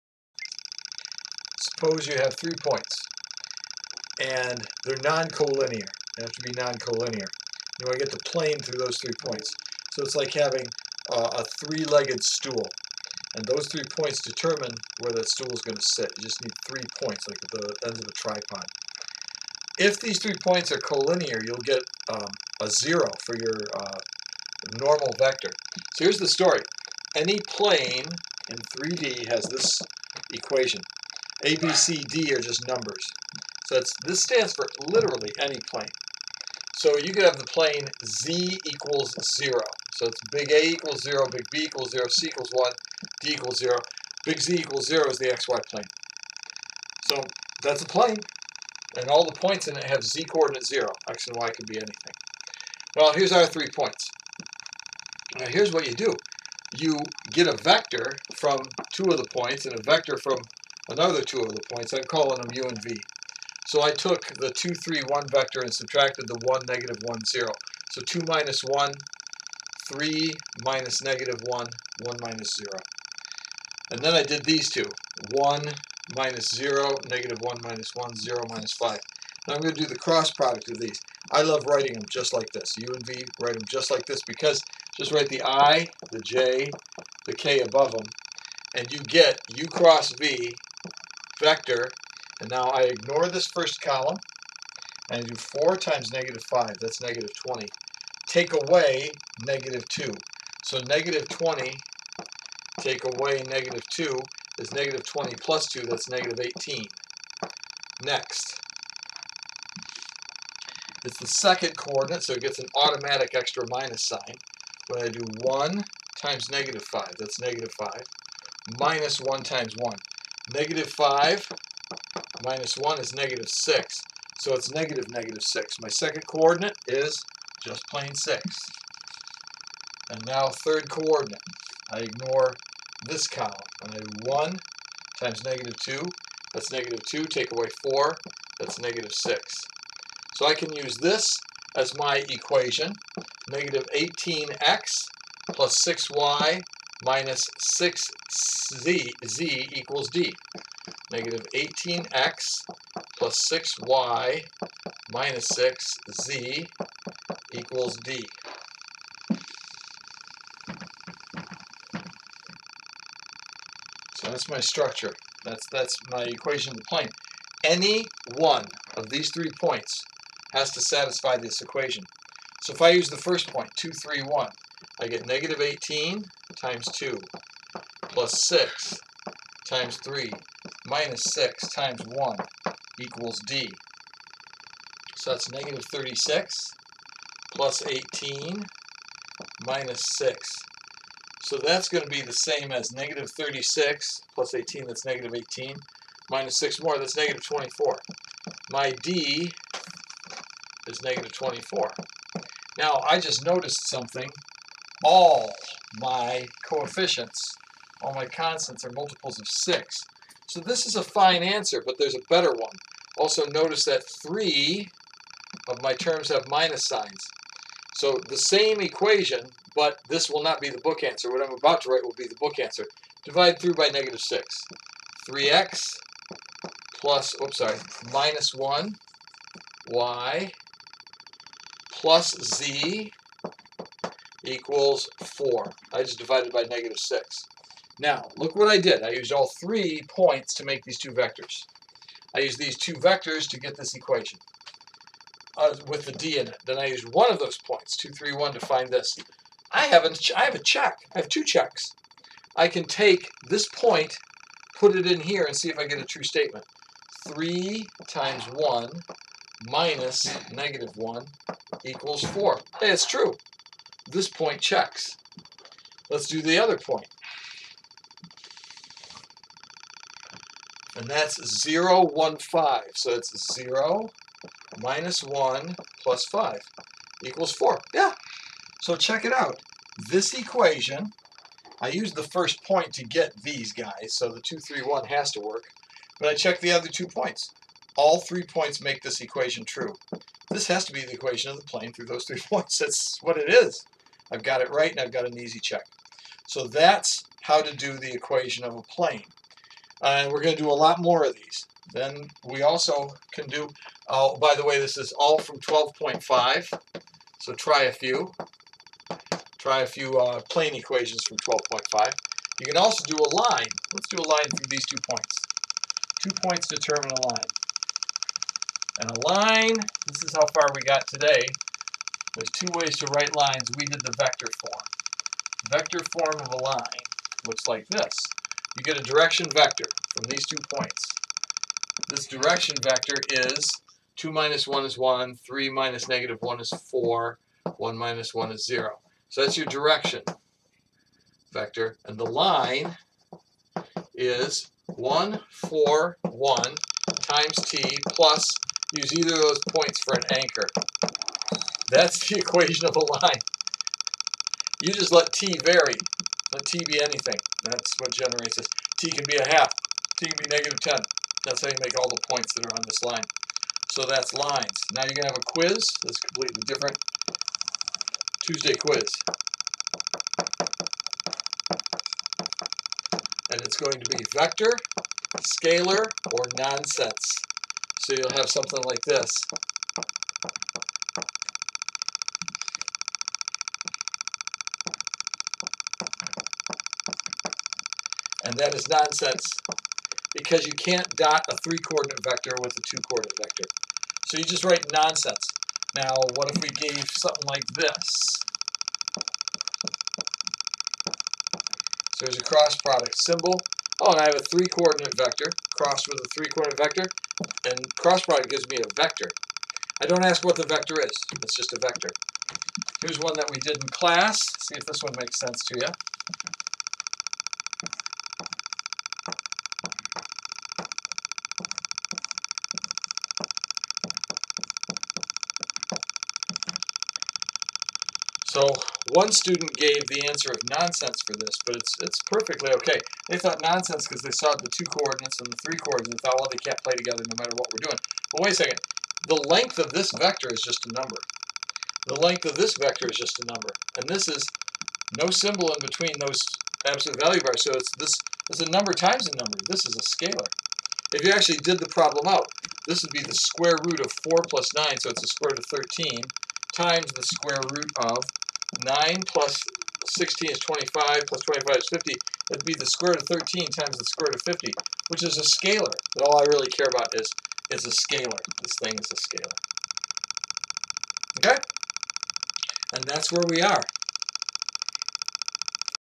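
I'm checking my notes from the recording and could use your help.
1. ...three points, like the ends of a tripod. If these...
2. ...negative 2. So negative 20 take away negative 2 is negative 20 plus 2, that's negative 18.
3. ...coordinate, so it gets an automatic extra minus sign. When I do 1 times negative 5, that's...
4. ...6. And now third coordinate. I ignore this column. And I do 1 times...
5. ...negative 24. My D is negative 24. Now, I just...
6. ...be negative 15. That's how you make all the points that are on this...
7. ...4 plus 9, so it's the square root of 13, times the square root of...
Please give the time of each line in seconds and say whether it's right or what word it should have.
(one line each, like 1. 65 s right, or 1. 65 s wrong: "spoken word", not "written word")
1. 16 s right
2. 99 s right
3. 111 s right
4. 128 s right
5. 197 s right
6. 360 s wrong: "10", not "15"
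7. 454 s right.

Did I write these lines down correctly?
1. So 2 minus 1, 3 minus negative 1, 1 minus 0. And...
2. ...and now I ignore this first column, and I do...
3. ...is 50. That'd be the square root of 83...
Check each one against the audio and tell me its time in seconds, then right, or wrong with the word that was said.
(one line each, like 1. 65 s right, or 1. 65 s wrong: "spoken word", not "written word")
1. 67 s right
2. 92 s right
3. 461 s wrong: "13", not "83".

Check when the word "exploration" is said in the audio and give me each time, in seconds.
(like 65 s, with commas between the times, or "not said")
not said.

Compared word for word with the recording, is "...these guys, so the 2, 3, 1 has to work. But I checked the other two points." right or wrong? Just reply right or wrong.
right.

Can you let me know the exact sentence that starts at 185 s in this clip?
So that's negative 36 plus 18 minus 6.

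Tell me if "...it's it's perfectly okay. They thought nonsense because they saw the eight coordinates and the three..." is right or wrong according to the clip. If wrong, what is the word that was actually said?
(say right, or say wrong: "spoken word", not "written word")
wrong: "two", not "eight".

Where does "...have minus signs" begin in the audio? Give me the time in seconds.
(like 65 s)
216 s.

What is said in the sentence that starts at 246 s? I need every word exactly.
Then I used one of those points, 2, 3, 1, to find this.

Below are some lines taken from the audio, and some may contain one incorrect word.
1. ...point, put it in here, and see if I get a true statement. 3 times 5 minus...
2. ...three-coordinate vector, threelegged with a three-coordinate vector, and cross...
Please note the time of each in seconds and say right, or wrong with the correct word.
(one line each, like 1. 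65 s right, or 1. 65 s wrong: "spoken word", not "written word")
1. 253 s wrong: "1", not "5"
2. 404 s wrong: "crossed", not "threelegged".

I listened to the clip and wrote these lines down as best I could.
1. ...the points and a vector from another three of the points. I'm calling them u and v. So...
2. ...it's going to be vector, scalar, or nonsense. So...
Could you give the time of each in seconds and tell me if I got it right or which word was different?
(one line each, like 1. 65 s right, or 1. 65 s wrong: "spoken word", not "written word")
1. 59 s wrong: "two", not "three"
2. 373 s right.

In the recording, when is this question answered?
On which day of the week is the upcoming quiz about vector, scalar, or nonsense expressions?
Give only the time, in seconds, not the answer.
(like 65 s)
368 s.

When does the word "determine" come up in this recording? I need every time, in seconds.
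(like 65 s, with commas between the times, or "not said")
14 s, 316 s.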